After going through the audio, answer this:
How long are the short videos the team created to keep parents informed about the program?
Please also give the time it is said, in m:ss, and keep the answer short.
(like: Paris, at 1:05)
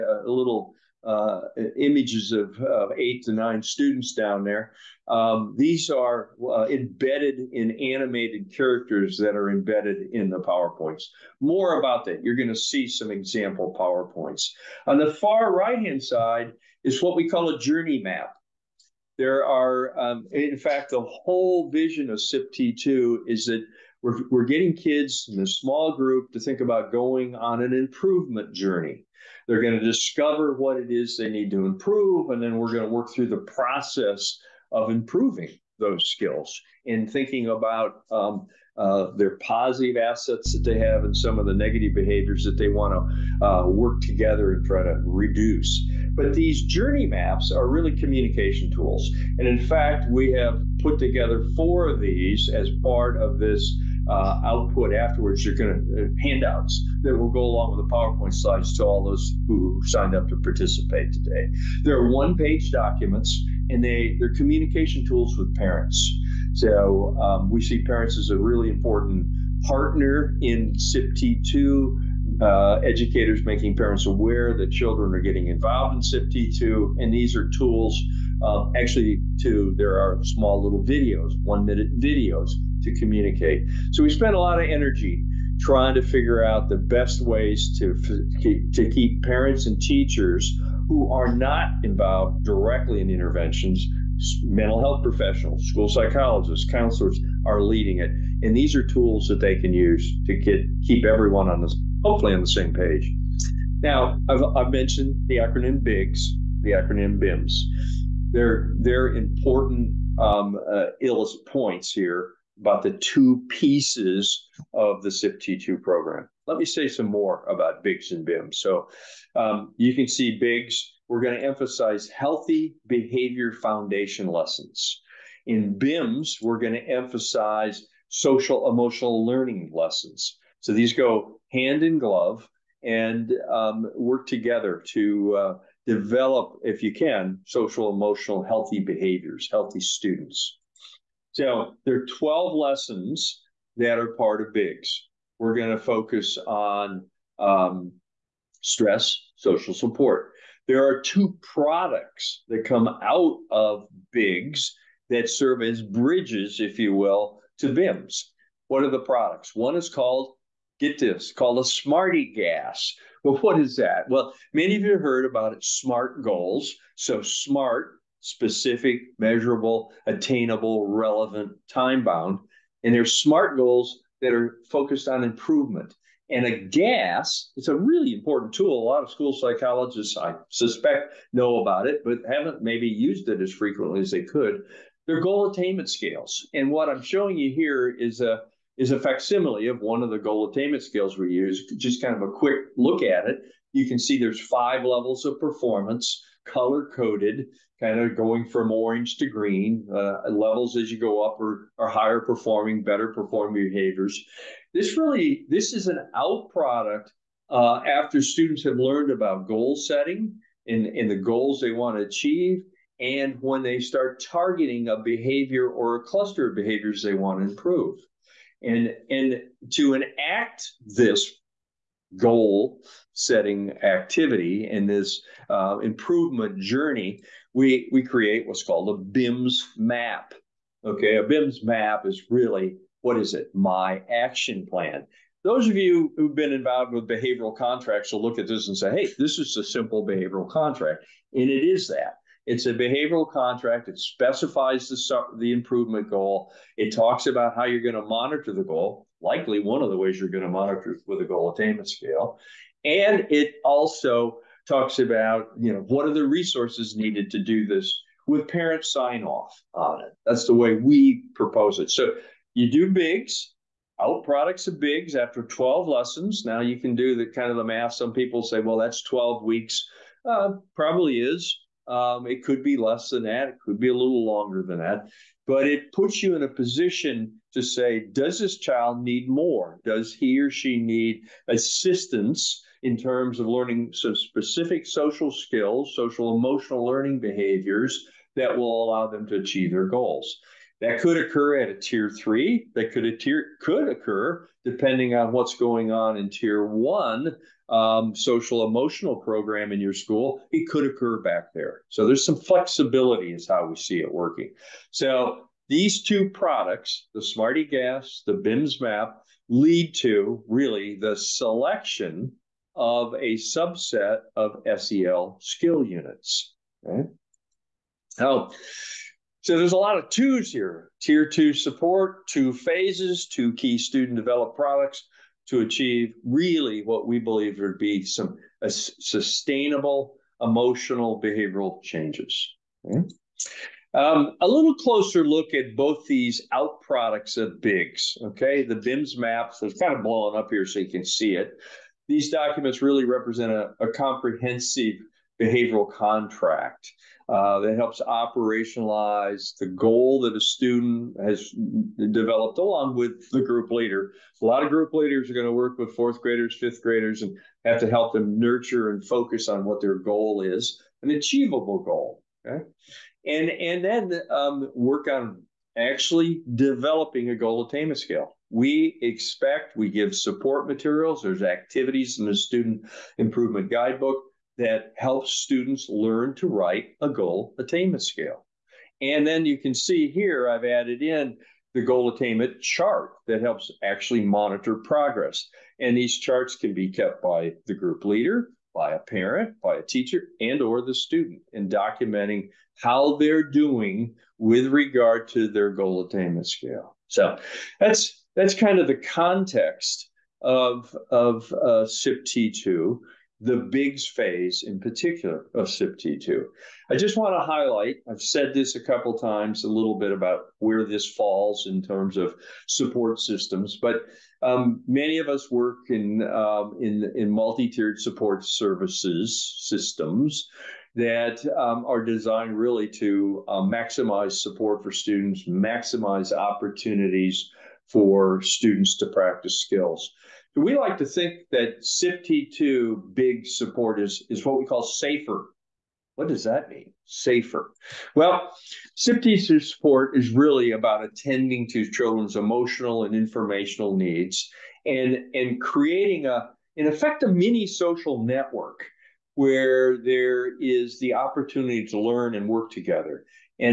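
one minute, at 1:21.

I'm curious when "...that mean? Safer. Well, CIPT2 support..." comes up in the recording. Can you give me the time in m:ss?
7:16.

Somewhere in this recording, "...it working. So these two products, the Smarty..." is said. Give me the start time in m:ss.
5:03.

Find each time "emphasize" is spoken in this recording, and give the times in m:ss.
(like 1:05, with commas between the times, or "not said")
2:01, 2:06.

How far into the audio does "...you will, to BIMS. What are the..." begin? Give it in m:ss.
2:36.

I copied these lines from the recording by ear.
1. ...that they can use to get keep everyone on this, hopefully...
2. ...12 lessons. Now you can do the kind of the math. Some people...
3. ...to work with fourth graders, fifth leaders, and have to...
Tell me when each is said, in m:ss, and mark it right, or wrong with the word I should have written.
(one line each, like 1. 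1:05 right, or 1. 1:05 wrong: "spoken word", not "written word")
1. 1:39 right
2. 4:25 right
3. 5:55 wrong: "graders", not "leaders".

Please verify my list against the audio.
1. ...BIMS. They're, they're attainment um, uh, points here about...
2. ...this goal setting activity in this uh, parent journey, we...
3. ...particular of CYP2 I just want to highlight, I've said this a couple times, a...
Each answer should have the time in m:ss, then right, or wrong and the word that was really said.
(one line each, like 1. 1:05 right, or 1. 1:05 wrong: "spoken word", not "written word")
1. 1:47 wrong: "important", not "attainment"
2. 3:40 wrong: "improvement", not "parent"
3. 6:44 right.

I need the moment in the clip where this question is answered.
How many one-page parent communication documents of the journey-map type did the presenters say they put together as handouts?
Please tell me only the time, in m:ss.
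0:51.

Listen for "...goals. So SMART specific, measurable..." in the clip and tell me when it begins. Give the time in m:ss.
2:46.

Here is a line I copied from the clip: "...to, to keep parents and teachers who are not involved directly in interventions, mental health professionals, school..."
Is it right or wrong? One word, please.
right.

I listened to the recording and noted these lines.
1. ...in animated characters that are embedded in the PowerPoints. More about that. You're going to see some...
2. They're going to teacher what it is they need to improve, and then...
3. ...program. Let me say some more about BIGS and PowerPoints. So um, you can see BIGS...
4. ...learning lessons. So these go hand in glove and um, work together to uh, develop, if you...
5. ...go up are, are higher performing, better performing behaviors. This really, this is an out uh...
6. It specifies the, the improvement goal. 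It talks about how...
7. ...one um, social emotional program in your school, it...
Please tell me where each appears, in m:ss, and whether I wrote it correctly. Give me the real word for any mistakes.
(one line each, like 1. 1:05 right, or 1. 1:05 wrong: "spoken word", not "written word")
1. 0:07 right
2. 0:29 wrong: "discover", not "teacher"
3. 1:55 wrong: "BIMS", not "PowerPoints"
4. 2:09 right
5. 3:20 right
6. 4:03 right
7. 4:56 right.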